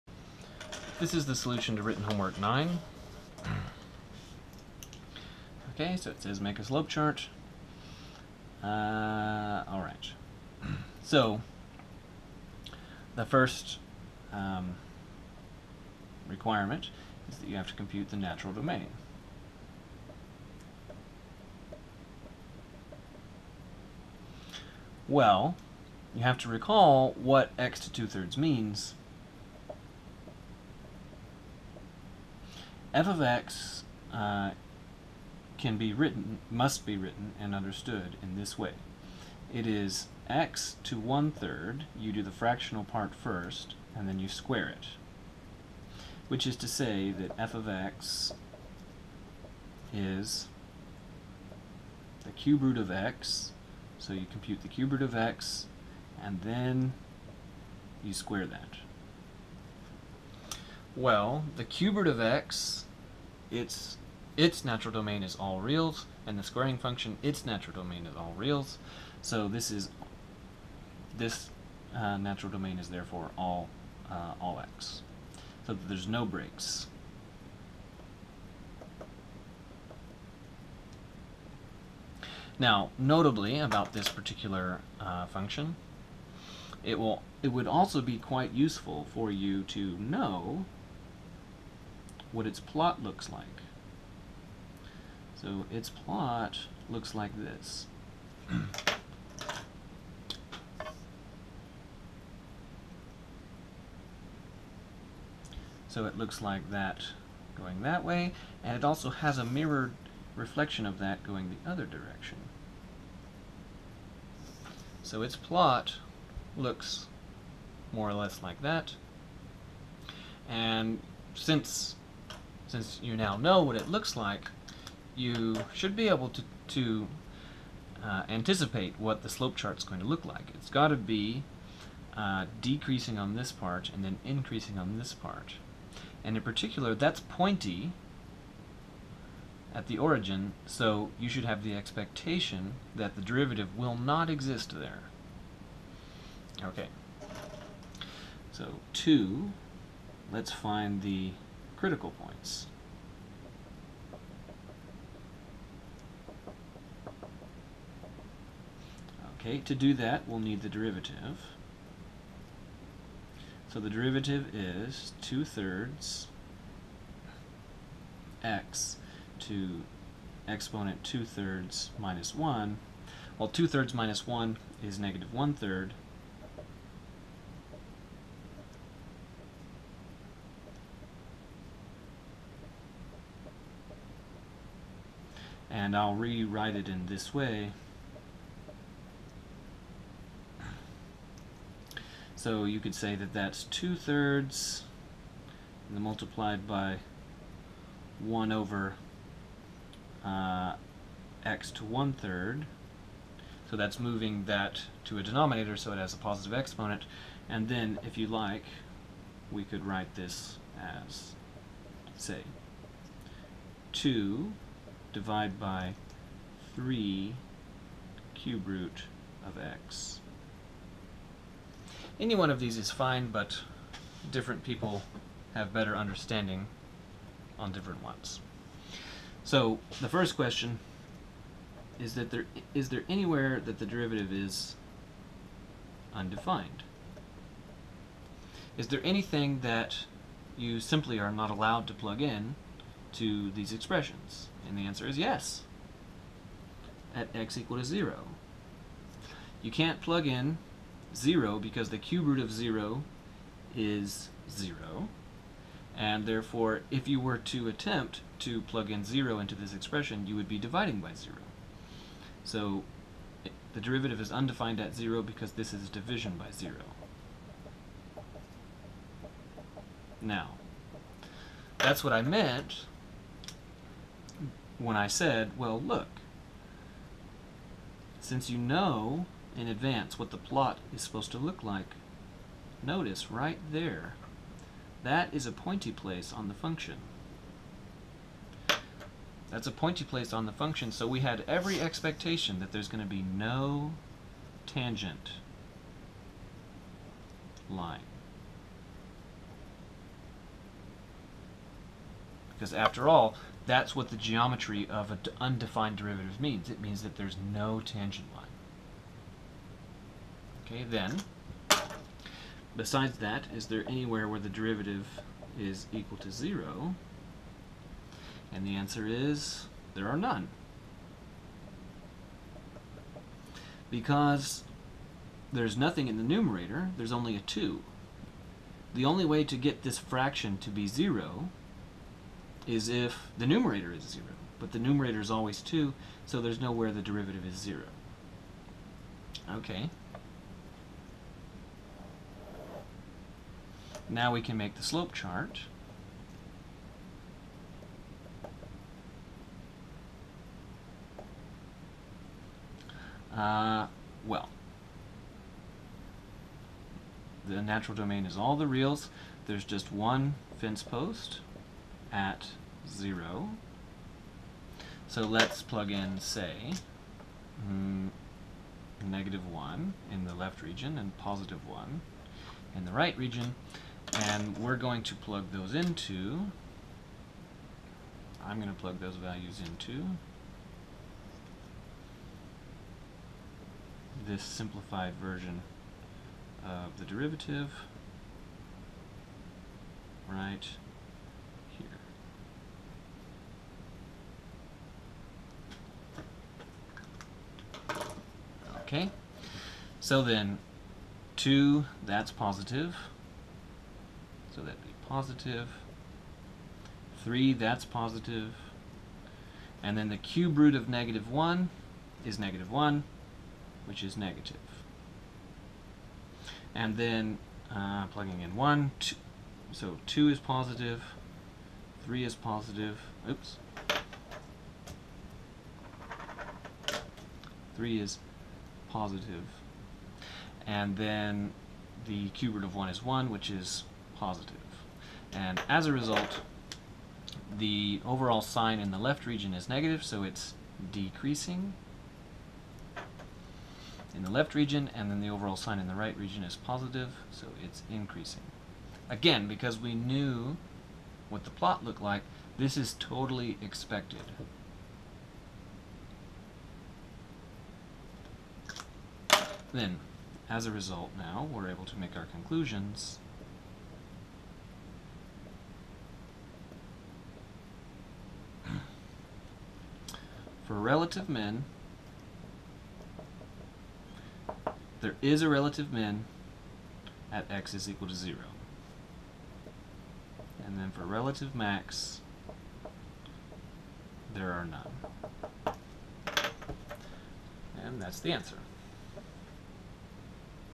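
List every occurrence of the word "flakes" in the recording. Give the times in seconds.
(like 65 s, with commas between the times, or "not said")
not said.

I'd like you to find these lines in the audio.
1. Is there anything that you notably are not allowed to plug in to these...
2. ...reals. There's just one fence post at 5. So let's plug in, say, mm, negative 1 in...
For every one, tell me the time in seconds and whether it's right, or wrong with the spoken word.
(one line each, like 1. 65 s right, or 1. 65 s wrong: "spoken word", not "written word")
1. 238 s wrong: "simply", not "notably"
2. 358 s wrong: "0", not "5".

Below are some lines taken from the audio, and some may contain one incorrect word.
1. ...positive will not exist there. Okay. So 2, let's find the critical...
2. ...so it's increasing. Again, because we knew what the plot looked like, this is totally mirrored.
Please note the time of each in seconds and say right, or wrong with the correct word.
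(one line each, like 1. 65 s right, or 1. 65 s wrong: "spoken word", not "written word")
1. 143 s wrong: "derivative", not "positive"
2. 447 s wrong: "expected", not "mirrored".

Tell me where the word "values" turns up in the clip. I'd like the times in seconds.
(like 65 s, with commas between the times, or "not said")
379 s.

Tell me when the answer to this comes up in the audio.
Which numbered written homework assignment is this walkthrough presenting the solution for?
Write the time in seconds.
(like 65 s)
1 s.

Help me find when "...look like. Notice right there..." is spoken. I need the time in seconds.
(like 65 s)
281 s.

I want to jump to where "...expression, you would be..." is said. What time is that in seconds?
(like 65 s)
259 s.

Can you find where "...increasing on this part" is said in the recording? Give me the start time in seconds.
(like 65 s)
134 s.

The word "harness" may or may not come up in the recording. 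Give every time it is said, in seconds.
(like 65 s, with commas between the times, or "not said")
not said.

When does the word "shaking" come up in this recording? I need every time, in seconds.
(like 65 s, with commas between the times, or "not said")
not said.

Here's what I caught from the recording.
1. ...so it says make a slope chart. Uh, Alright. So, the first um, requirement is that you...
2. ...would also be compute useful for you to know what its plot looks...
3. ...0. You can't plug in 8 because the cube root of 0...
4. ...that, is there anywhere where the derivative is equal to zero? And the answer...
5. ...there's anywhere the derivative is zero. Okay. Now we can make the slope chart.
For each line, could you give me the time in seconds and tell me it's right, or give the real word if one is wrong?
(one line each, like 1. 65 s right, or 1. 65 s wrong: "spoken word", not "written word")
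1. 5 s right
2. 87 s wrong: "quite", not "compute"
3. 247 s wrong: "0", not "8"
4. 313 s right
5. 336 s wrong: "nowhere", not "anywhere".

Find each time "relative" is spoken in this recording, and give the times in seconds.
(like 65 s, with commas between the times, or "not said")
470 s, 475 s, 481 s.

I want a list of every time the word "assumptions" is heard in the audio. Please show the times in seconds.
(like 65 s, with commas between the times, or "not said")
not said.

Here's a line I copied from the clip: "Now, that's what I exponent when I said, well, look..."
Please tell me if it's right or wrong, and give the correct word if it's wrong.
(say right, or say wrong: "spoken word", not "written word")
wrong: "meant", not "exponent".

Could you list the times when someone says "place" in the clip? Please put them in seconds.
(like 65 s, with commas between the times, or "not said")
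285 s, 290 s.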